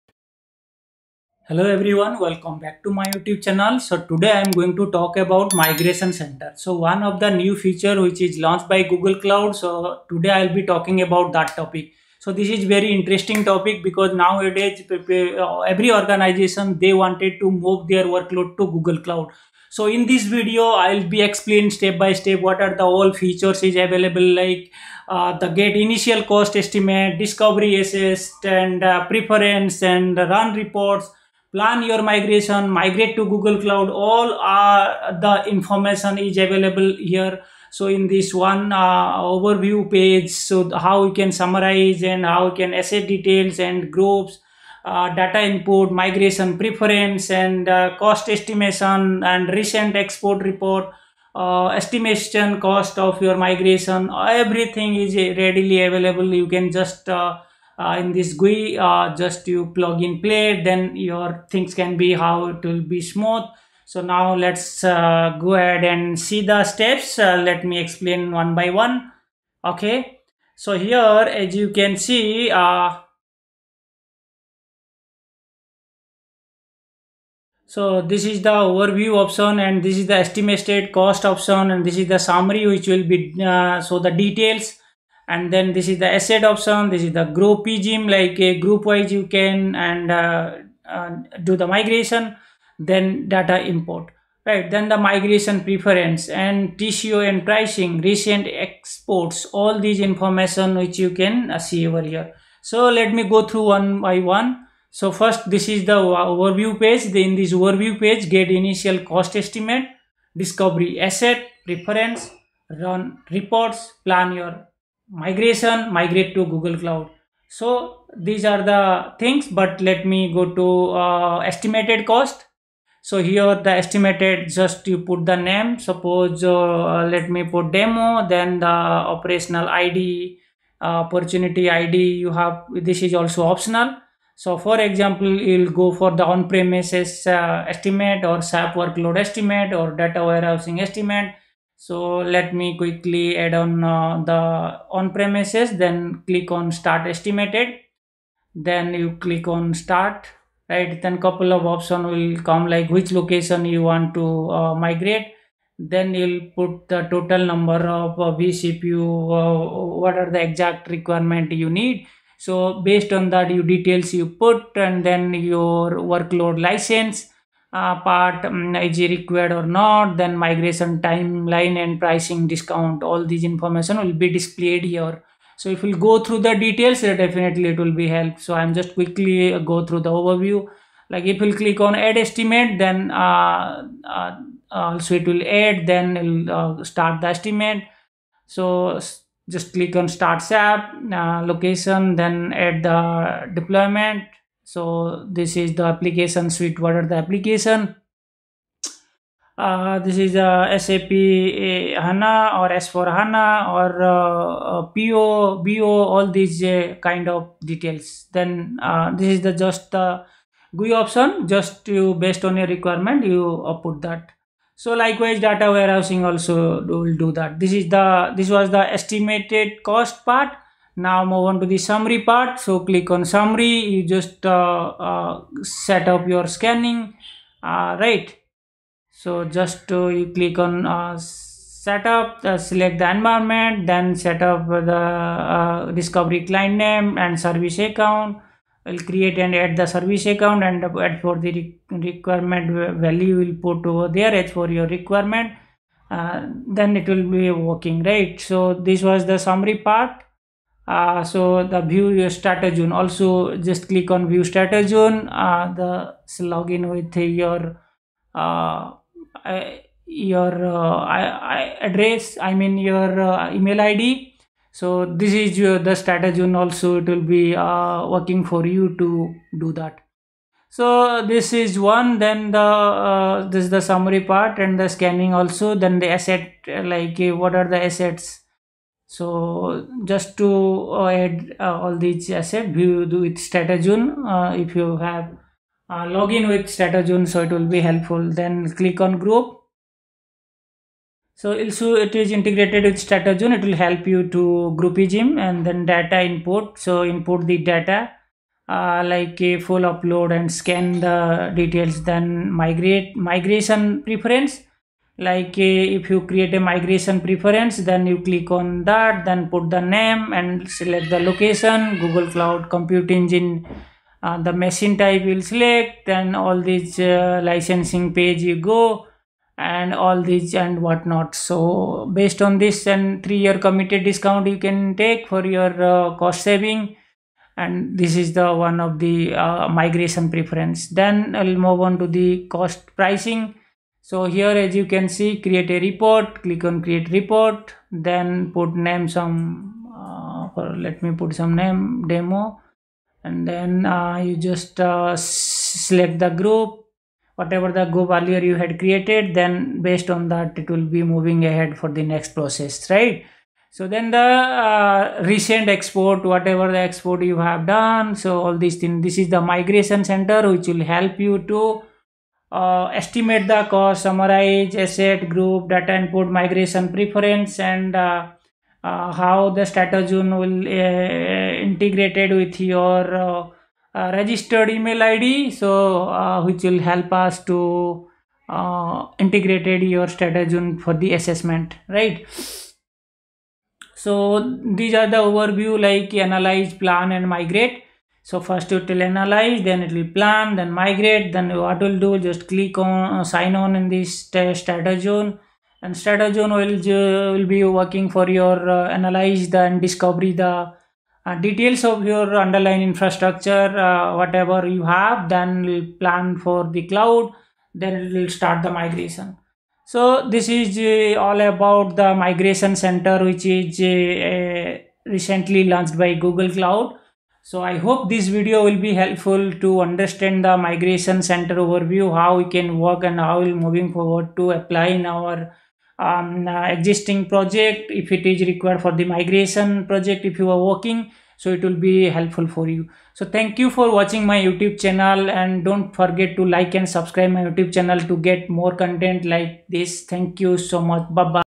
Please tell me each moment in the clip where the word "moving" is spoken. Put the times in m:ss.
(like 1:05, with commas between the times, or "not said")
5:51, 7:03.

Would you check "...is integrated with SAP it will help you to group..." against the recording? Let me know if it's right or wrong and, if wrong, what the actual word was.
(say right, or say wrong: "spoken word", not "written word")
wrong: "StratoZone", not "SAP".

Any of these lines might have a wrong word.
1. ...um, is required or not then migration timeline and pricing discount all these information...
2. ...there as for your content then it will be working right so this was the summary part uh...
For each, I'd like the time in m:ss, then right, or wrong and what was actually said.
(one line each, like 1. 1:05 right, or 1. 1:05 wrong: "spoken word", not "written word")
1. 2:48 right
2. 4:04 wrong: "requirement", not "content".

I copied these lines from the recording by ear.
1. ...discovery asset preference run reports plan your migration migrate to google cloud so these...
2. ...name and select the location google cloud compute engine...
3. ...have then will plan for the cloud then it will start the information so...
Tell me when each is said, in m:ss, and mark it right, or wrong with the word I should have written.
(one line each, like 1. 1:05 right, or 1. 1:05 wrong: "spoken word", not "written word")
1. 1:50 right
2. 5:09 right
3. 6:44 wrong: "migration", not "information".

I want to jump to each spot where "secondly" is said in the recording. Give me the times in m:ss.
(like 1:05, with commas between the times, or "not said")
not said.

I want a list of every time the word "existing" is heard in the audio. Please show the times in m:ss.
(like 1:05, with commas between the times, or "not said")
7:06.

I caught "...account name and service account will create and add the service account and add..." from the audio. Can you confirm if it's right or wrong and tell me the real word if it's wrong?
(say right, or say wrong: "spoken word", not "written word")
wrong: "client", not "account".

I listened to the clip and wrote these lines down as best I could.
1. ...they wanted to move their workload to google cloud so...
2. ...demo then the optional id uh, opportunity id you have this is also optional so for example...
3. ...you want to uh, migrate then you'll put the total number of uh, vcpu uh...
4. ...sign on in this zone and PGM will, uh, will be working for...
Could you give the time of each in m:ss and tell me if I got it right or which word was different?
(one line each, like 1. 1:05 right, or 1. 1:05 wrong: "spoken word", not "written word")
1. 0:16 right
2. 2:07 wrong: "operational", not "optional"
3. 2:33 right
4. 6:33 wrong: "StratoZone", not "PGM".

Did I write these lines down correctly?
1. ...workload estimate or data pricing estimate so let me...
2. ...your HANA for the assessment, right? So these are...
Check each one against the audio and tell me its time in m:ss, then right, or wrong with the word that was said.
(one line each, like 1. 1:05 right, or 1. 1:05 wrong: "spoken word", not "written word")
1. 2:18 wrong: "warehousing", not "pricing"
2. 6:19 wrong: "StratoZone", not "HANA".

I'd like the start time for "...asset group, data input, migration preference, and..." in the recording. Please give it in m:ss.
6:04.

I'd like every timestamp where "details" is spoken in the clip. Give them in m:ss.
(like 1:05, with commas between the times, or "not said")
0:43, 1:24, 2:43, 2:56, 3:27, 5:01, 6:41.